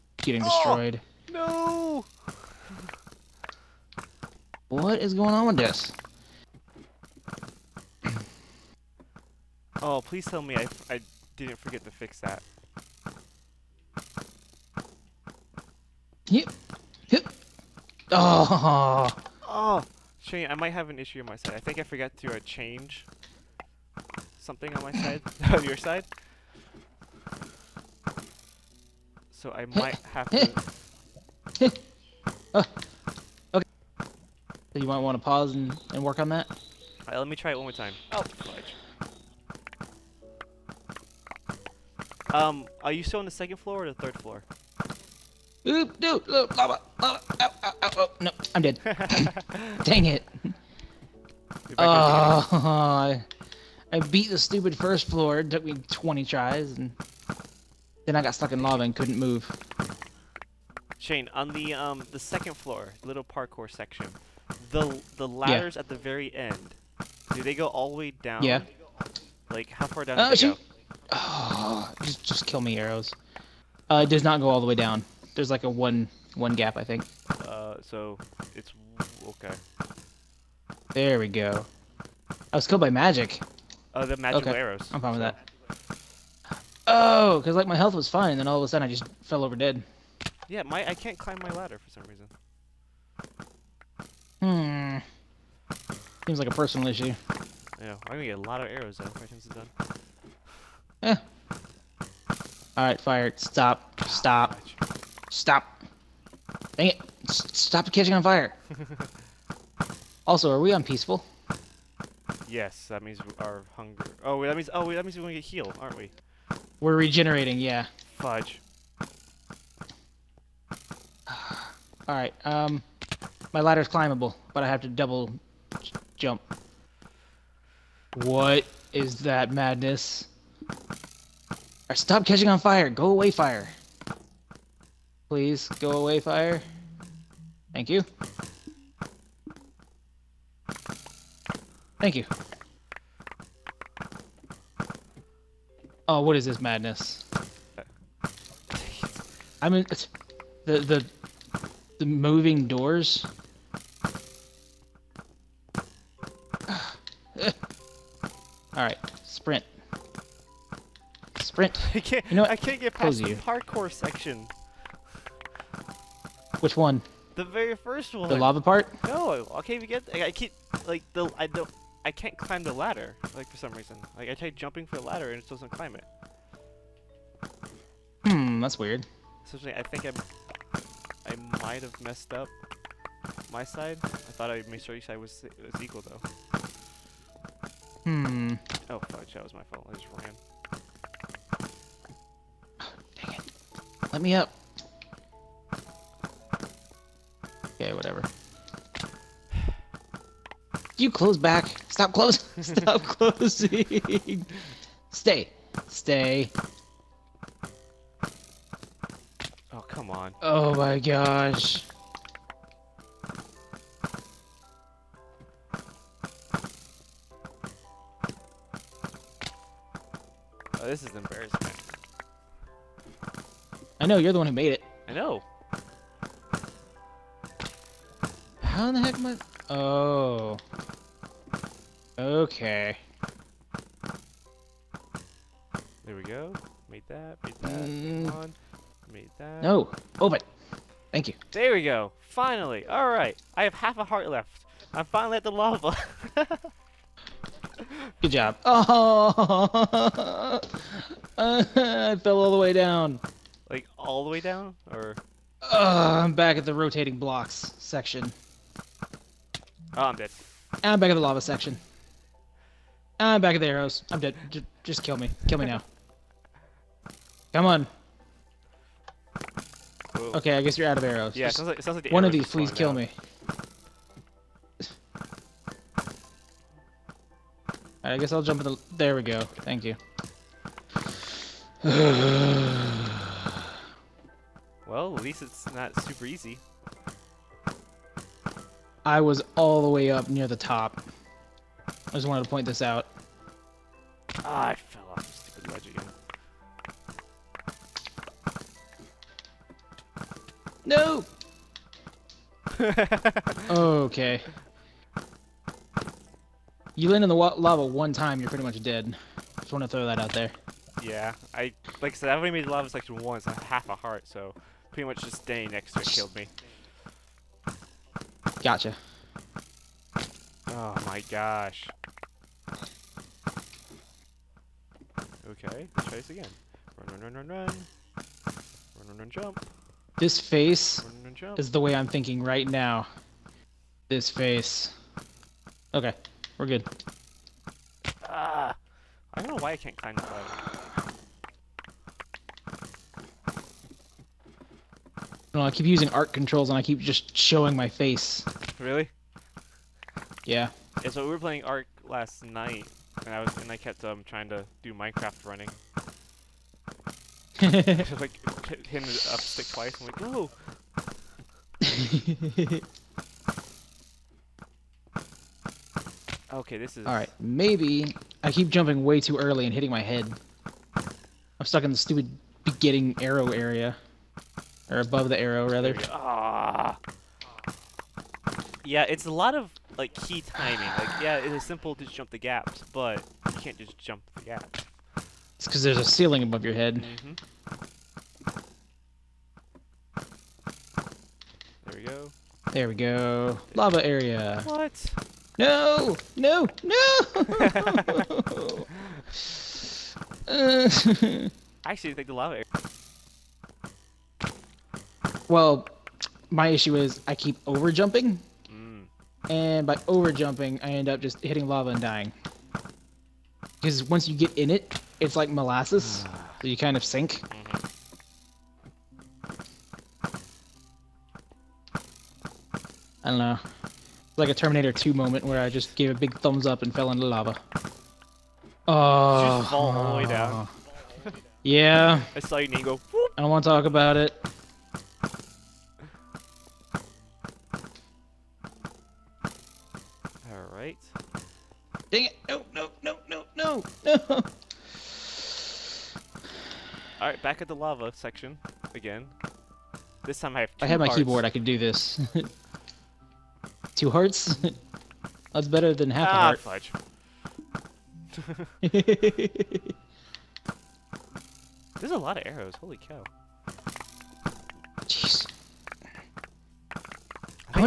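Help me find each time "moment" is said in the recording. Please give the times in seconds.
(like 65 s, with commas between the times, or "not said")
425 s.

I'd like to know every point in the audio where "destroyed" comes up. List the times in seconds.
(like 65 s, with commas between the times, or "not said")
0 s.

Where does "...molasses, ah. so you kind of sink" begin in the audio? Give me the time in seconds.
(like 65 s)
415 s.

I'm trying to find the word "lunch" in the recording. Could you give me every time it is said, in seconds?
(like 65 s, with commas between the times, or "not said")
not said.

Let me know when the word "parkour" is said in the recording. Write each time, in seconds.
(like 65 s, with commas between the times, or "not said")
63 s, 163 s.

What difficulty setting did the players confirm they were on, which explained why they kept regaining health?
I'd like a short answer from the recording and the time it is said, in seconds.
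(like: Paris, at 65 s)
Peaceful, at 110 s.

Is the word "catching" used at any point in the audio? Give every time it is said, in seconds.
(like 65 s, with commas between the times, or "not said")
107 s, 132 s.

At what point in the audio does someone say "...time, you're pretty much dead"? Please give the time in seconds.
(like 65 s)
308 s.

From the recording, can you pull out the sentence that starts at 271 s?
Yeah, it sounds like, it sounds like One of these, please kill me.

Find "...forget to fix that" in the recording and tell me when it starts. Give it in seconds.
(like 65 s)
11 s.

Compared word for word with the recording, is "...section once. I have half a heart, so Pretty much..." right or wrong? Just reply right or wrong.
right.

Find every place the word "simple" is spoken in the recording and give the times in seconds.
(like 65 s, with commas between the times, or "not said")
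381 s.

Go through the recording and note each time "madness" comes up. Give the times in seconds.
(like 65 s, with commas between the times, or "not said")
129 s, 146 s.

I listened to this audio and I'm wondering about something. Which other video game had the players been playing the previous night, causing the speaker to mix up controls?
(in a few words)
Ark.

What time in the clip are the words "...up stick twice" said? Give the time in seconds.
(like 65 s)
359 s.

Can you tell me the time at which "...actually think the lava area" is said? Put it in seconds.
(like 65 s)
401 s.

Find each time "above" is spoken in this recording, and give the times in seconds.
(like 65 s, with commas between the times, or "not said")
375 s, 386 s.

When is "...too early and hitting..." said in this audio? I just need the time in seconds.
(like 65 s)
369 s.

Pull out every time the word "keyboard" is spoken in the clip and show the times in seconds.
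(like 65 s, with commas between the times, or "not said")
451 s.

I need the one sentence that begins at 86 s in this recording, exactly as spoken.
Oh, because like my health was fine, and then all of a sudden I just fell over dead.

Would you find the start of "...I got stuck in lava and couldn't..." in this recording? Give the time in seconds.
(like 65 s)
58 s.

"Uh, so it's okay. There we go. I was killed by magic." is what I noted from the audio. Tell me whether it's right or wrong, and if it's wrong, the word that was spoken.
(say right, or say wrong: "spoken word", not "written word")
right.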